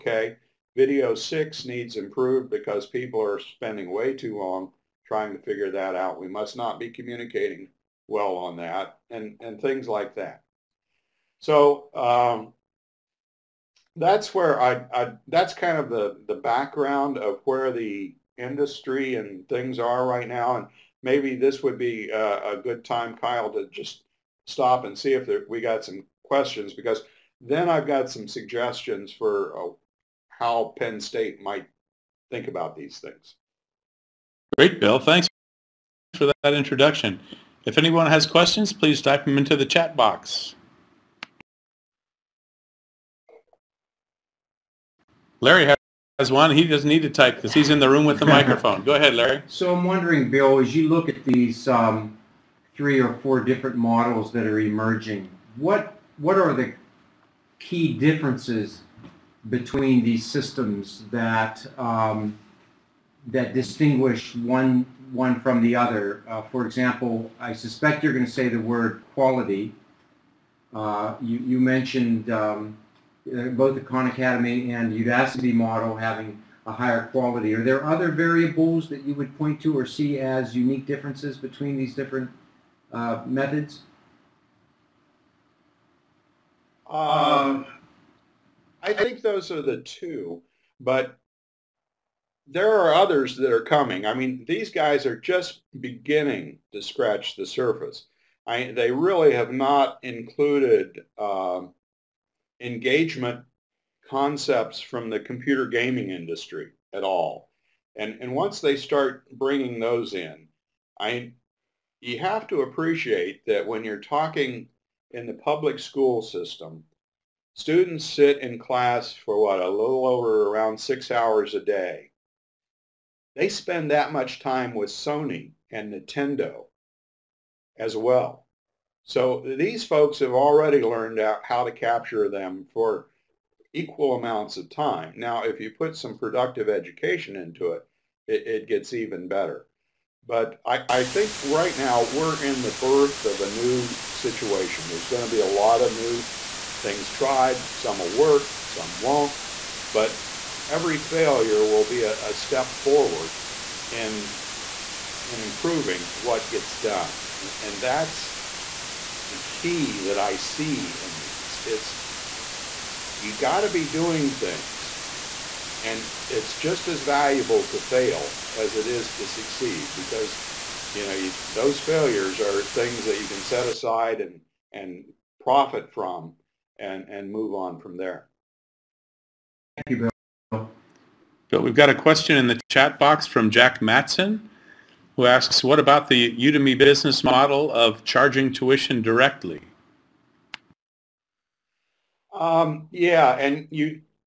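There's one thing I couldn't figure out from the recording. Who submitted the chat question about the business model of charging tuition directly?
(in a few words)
Jack Matson.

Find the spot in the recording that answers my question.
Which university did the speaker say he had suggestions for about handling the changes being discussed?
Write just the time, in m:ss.
0:30.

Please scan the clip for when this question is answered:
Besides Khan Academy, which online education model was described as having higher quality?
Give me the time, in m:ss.
1:14.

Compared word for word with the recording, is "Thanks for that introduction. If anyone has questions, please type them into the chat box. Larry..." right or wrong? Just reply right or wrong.
right.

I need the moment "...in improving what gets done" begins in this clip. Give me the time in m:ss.
2:35.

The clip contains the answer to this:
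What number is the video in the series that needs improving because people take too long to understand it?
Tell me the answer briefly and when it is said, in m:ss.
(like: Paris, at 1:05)
6, at 0:00.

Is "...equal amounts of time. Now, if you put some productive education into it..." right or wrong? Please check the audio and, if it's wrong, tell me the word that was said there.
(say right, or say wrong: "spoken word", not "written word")
right.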